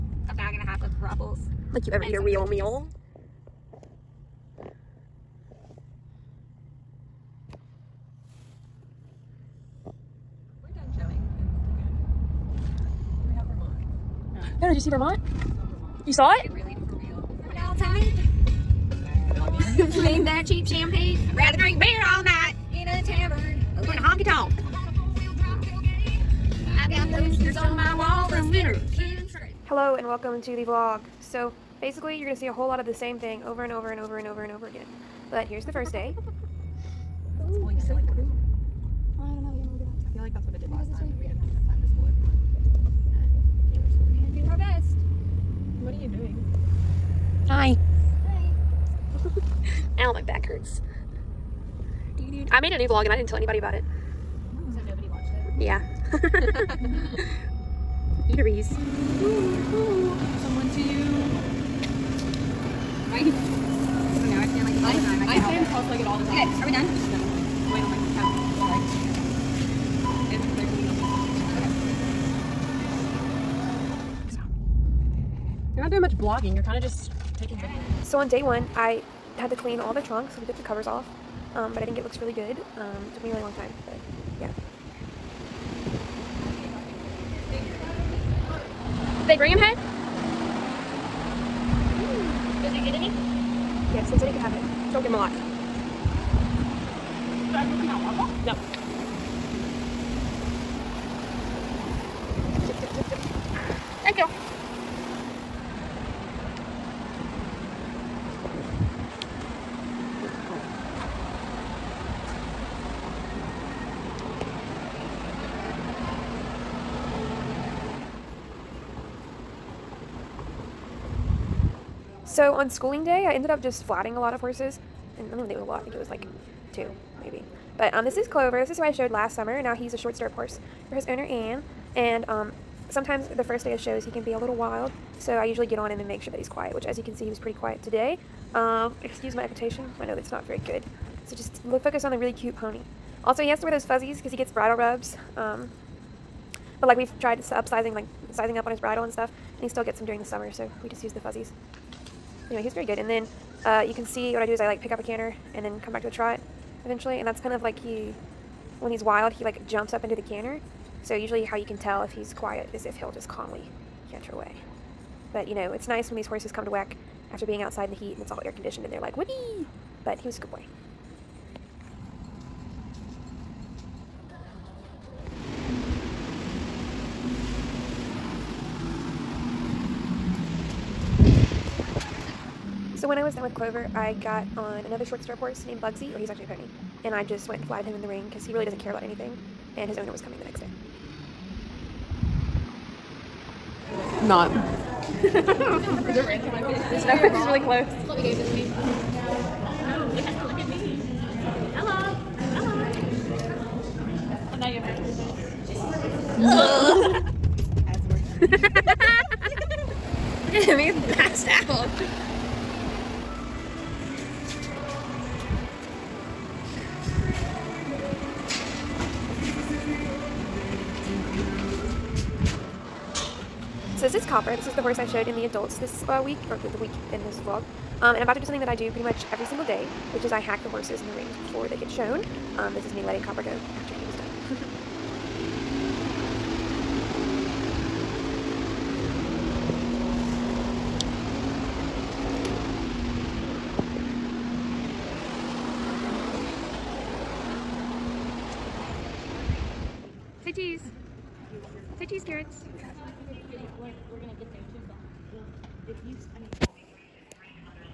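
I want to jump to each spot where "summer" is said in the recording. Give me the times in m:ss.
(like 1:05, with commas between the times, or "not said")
2:09, 2:30.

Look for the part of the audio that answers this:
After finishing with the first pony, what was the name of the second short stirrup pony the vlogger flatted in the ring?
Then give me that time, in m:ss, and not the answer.
3:05.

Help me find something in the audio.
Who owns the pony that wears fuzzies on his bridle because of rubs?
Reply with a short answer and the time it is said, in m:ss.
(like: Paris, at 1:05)
Anne, at 2:11.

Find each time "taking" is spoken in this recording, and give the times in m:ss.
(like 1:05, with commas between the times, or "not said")
1:17.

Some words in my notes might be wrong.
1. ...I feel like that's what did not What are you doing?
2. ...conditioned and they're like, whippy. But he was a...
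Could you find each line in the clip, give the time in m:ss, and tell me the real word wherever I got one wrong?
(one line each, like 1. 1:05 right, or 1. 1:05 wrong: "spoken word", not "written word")
1. 0:37 right
2. 2:48 right.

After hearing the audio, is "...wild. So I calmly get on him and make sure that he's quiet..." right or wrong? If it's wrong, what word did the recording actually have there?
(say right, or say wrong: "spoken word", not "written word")
wrong: "usually", not "calmly".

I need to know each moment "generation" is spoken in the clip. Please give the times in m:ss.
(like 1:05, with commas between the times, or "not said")
not said.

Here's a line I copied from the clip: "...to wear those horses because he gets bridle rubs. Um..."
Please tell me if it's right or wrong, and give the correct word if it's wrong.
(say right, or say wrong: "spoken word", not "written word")
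wrong: "fuzzies", not "horses".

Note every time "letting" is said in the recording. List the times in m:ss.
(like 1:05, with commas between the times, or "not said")
3:53.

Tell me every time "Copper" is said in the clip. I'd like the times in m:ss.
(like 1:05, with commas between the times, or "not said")
3:44, 3:53.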